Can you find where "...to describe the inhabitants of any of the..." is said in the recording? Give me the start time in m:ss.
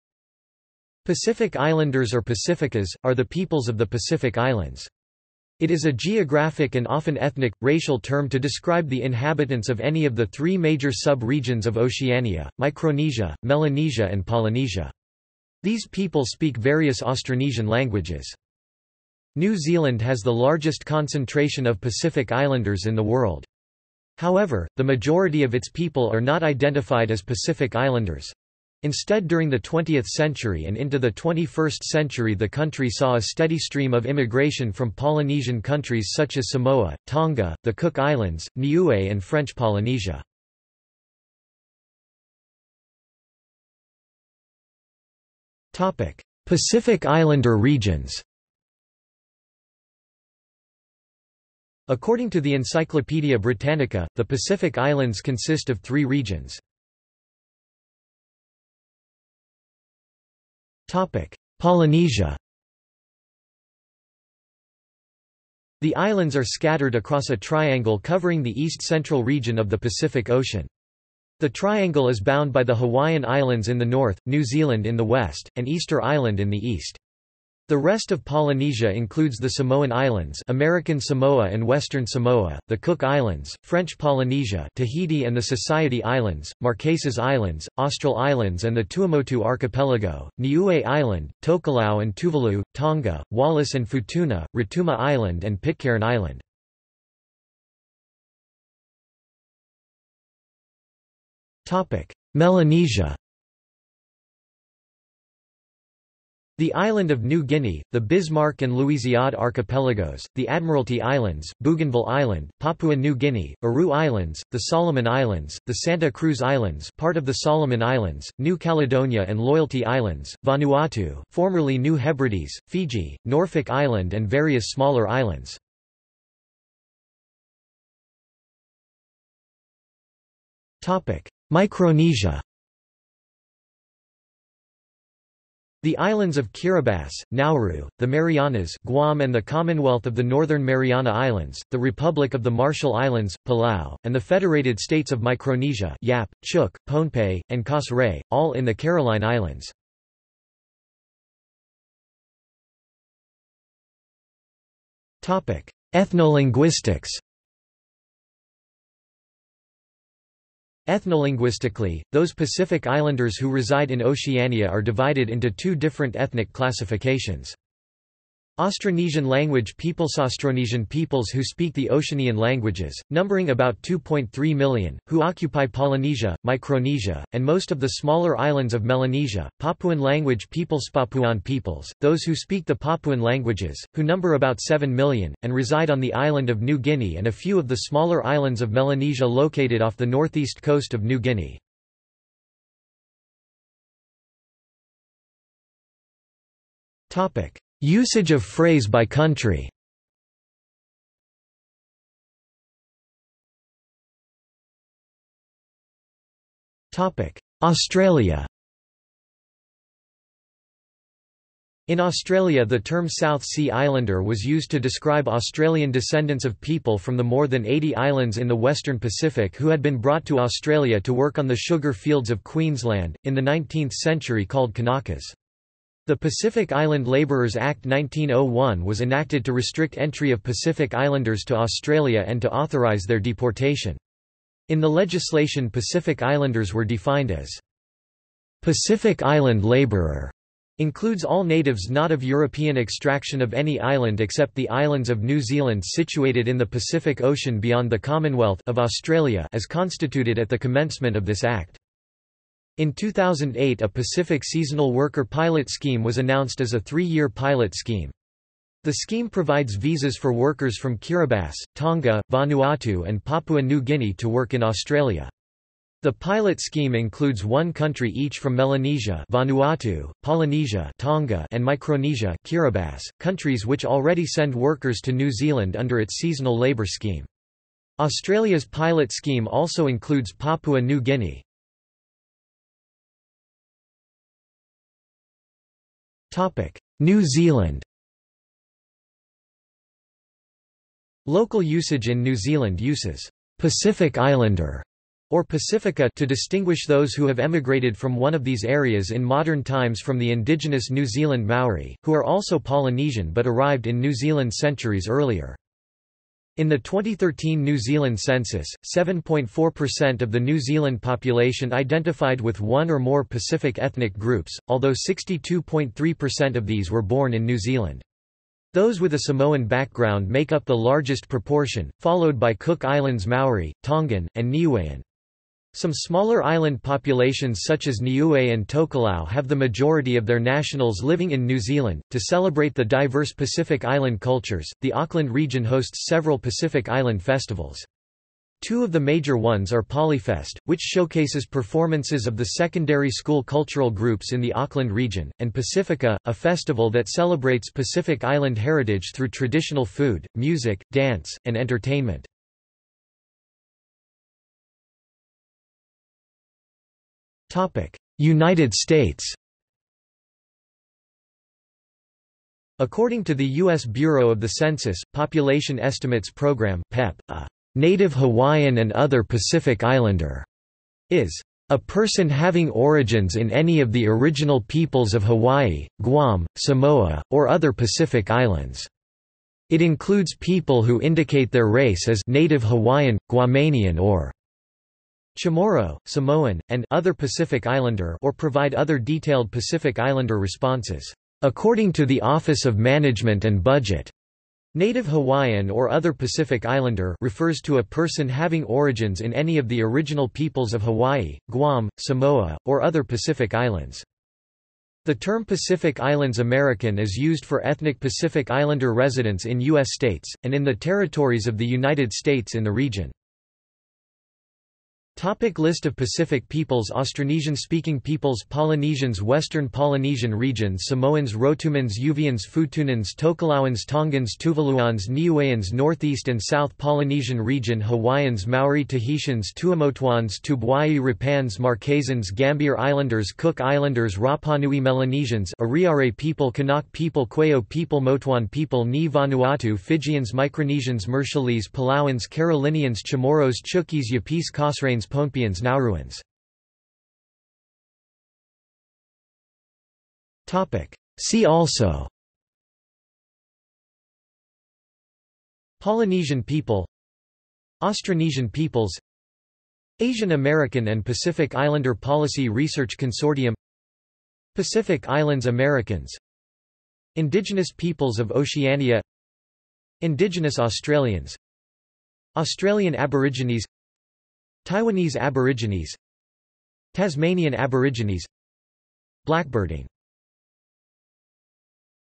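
0:08.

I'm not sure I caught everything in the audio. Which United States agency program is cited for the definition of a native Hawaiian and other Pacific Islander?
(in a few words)
Population Estimates Program.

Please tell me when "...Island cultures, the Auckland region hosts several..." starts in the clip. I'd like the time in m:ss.
5:33.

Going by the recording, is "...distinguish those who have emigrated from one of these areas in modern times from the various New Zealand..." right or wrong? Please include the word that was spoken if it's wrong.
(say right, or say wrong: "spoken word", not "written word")
wrong: "indigenous", not "various".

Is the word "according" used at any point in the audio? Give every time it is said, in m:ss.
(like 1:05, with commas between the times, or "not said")
0:51, 6:02, 6:31.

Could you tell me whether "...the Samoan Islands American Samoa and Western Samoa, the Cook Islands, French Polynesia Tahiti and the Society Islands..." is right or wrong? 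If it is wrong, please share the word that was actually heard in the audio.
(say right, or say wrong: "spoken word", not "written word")
right.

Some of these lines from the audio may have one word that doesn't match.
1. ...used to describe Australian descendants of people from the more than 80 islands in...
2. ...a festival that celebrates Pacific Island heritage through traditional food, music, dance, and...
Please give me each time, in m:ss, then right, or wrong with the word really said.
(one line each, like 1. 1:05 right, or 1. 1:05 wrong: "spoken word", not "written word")
1. 3:34 right
2. 5:46 right.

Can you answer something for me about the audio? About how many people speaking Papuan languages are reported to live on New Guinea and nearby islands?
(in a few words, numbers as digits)
7 million.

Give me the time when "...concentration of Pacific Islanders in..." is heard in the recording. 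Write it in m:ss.
0:20.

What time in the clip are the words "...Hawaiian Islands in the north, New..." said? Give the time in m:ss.
1:12.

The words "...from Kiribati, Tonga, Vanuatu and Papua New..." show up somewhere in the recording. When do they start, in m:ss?
4:20.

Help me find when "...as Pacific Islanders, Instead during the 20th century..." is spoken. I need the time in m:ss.
0:27.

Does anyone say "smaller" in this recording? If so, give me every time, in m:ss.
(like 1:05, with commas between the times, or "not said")
2:04, 2:57, 3:07, 5:25.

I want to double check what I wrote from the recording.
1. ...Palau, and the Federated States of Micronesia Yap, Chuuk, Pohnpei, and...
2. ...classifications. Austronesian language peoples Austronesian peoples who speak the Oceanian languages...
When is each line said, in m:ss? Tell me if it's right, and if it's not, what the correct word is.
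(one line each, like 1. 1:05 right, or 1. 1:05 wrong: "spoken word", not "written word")
1. 2:23 right
2. 2:46 right.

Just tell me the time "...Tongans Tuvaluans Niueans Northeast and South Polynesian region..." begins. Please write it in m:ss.
7:03.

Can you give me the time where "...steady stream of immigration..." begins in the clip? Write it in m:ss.
0:33.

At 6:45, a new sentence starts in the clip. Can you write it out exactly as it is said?
The term Pacific Islands American is used for ethnic Pacific Islander residents in U.S.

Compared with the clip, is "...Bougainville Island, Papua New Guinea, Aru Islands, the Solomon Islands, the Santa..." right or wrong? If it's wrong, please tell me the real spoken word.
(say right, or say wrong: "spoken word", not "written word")
right.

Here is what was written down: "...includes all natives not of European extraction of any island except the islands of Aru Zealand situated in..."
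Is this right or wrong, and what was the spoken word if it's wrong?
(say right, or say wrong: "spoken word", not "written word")
wrong: "New", not "Aru".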